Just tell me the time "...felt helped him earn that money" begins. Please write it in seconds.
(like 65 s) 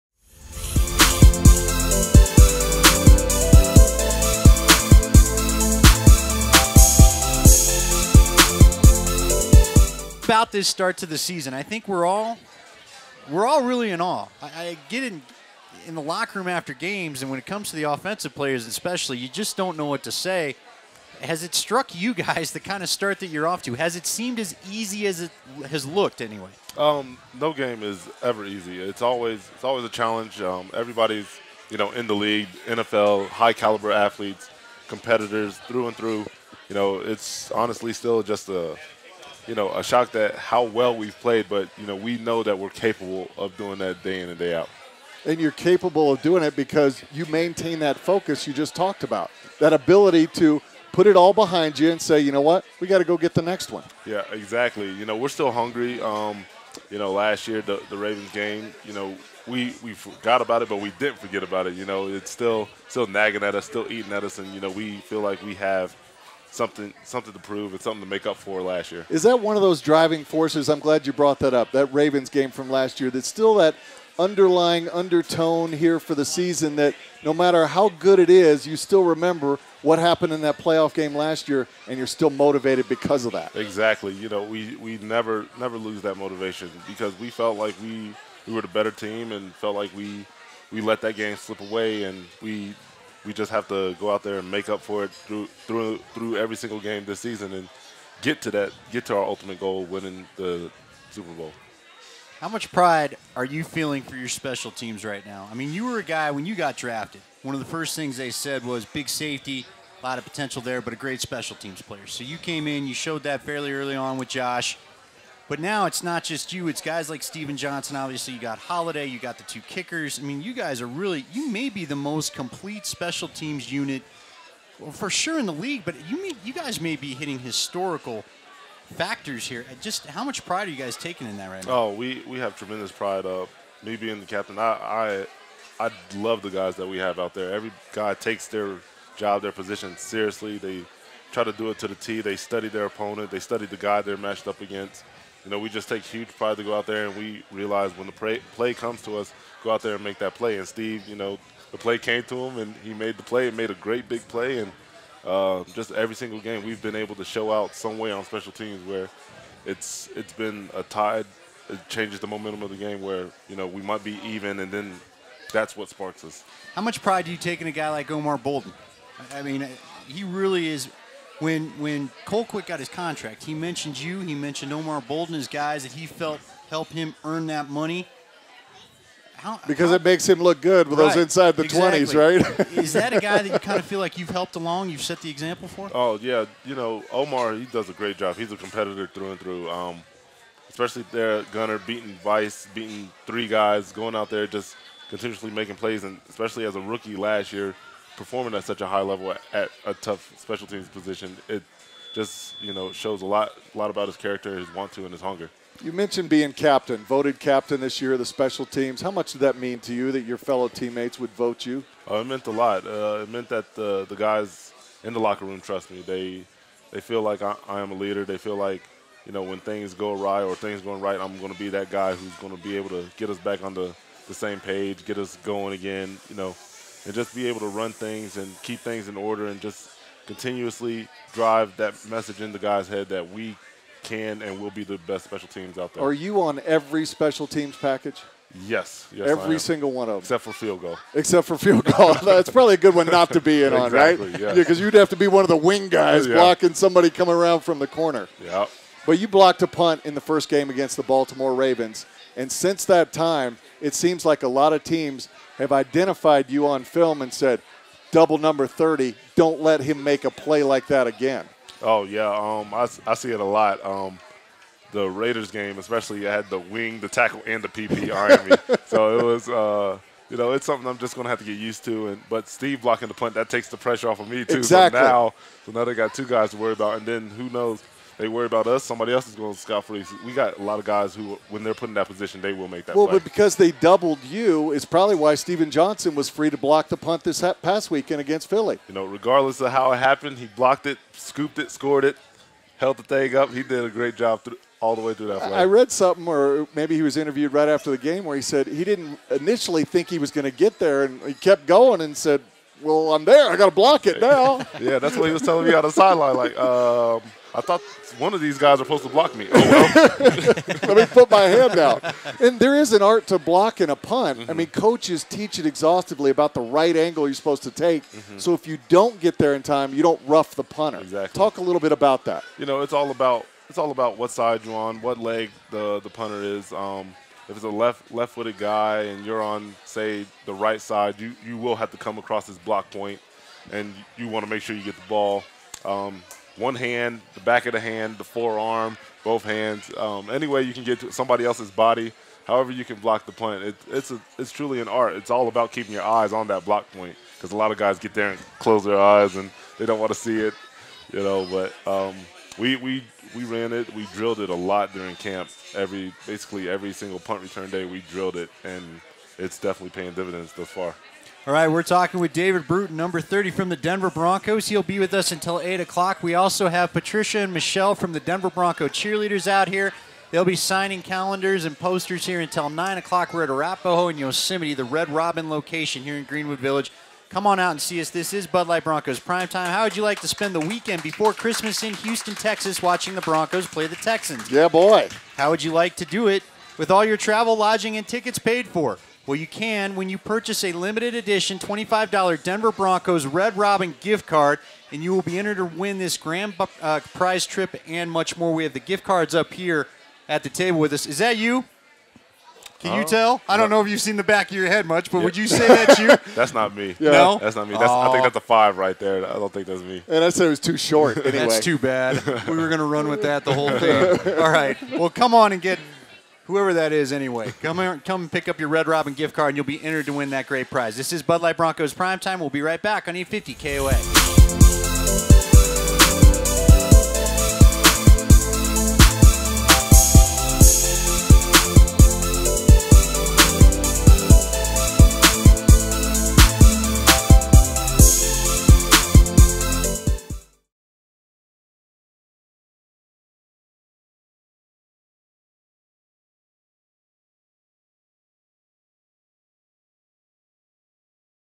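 176 s.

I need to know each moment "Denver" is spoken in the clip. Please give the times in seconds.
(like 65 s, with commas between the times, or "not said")
363 s, 368 s, 392 s.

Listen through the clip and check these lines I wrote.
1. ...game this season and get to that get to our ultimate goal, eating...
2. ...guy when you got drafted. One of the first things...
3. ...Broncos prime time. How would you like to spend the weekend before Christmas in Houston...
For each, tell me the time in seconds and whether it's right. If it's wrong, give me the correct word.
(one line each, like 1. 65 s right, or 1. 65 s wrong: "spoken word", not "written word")
1. 96 s wrong: "winning", not "eating"
2. 106 s right
3. 378 s right.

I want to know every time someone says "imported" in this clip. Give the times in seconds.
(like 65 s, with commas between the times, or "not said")
not said.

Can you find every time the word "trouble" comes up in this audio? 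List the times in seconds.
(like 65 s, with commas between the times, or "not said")
not said.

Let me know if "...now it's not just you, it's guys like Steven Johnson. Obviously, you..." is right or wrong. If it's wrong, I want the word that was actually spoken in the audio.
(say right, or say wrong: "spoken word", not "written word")
right.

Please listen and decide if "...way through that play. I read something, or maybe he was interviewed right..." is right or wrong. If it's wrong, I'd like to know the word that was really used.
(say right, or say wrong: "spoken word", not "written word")
right.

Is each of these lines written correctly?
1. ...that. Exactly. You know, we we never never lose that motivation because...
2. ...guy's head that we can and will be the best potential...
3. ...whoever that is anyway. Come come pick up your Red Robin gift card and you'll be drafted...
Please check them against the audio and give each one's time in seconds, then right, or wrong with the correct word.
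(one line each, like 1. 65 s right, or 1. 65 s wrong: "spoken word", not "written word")
1. 83 s right
2. 232 s wrong: "special", not "potential"
3. 416 s wrong: "entered", not "drafted".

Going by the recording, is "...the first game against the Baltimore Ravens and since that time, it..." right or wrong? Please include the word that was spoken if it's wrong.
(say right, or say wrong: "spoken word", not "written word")
right.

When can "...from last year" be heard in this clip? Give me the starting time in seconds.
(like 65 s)
72 s.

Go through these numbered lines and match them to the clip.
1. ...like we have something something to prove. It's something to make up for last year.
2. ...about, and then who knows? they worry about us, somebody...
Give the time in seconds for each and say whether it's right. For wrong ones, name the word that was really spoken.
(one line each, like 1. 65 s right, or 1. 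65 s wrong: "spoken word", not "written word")
1. 65 s right
2. 276 s right.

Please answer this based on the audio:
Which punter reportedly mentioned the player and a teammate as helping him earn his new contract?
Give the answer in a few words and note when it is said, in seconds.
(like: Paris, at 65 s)
Colquitt, at 172 s.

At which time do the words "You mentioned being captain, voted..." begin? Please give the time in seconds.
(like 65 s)
205 s.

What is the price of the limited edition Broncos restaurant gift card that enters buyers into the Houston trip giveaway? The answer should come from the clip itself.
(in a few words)
$25.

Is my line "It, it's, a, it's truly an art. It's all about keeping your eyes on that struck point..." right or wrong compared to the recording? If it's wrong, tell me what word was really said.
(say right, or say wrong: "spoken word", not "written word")
wrong: "block", not "struck".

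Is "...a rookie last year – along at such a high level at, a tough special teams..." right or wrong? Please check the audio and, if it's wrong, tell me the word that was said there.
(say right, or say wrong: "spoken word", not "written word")
wrong: "performing", not "along".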